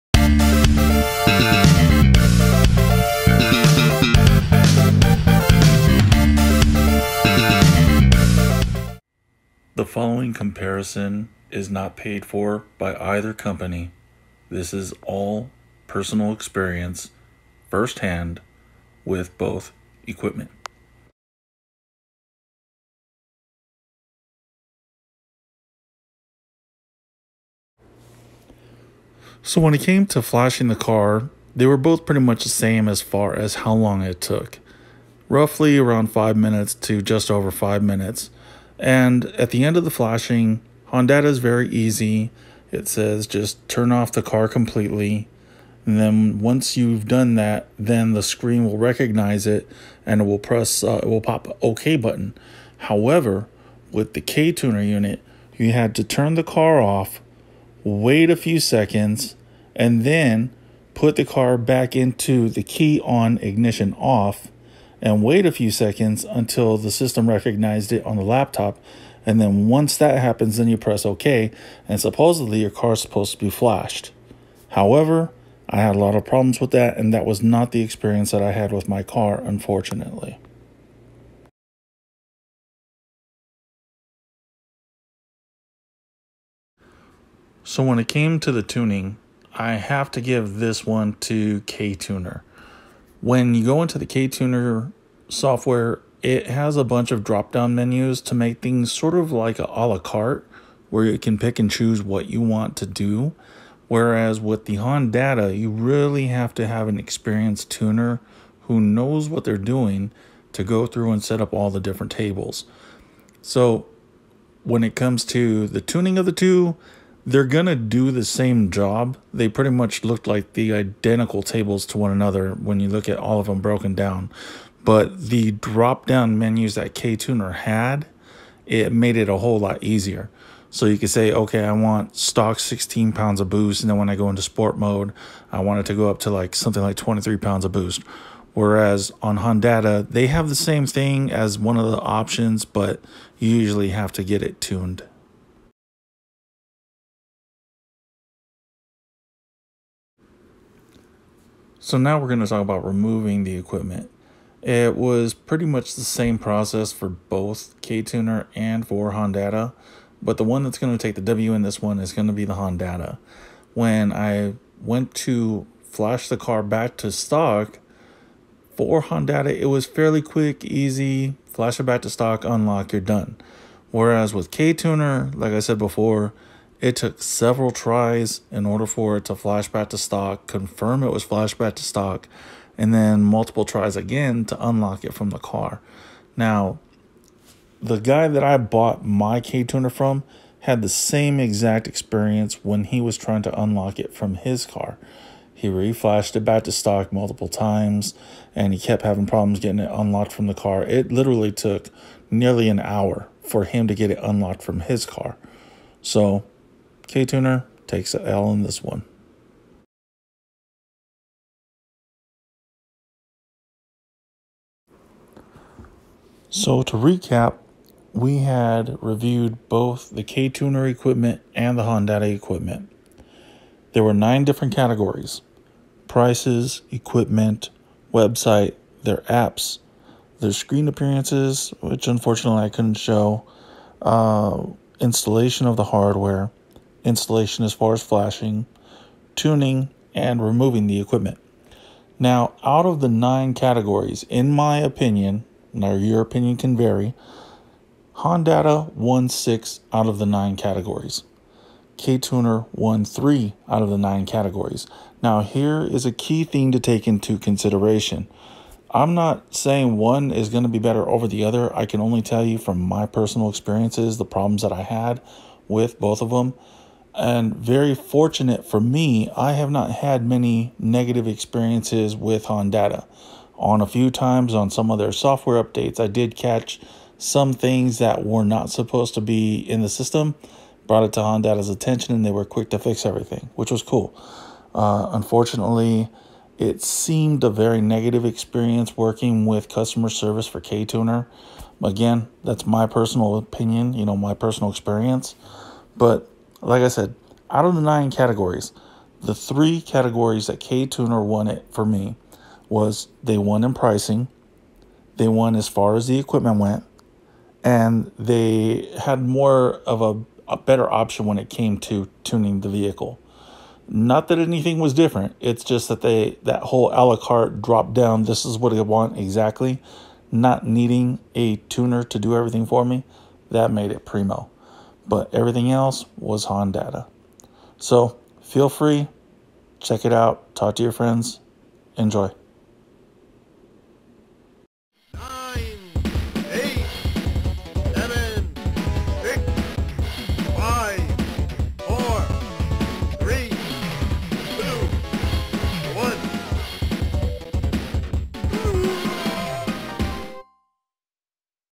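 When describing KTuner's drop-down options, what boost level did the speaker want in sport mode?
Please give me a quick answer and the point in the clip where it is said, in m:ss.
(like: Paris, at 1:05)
23 pounds, at 2:16.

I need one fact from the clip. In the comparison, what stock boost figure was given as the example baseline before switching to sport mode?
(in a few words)
16 pounds.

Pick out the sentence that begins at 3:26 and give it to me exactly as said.
So K-Tuner takes an L in this one.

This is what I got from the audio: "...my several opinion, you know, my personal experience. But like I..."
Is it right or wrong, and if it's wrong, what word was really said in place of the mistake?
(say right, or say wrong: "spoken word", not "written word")
wrong: "personal", not "several".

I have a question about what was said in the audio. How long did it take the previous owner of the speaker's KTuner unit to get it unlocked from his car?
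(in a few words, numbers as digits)
nearly an hour.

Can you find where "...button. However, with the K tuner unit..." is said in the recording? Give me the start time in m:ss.
0:51.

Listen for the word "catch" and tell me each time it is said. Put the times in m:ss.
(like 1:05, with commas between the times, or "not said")
4:36.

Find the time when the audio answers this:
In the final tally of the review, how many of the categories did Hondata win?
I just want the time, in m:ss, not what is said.
4:09.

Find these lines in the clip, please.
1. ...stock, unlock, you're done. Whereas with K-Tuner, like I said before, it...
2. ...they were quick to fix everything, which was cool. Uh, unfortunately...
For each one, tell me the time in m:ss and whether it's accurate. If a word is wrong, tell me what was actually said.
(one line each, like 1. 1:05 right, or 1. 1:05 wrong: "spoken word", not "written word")
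1. 2:52 right
2. 4:42 right.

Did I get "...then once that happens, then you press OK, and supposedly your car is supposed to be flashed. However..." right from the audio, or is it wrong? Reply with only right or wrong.
right.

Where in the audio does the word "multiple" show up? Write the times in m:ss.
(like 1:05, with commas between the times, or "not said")
3:03, 3:17.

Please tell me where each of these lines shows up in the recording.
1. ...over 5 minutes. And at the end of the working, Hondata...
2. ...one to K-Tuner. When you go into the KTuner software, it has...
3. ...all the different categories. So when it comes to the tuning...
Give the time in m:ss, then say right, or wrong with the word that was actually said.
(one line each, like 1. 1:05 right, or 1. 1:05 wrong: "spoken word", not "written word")
1. 0:37 wrong: "flashing", not "working"
2. 1:30 right
3. 1:51 wrong: "tables", not "categories".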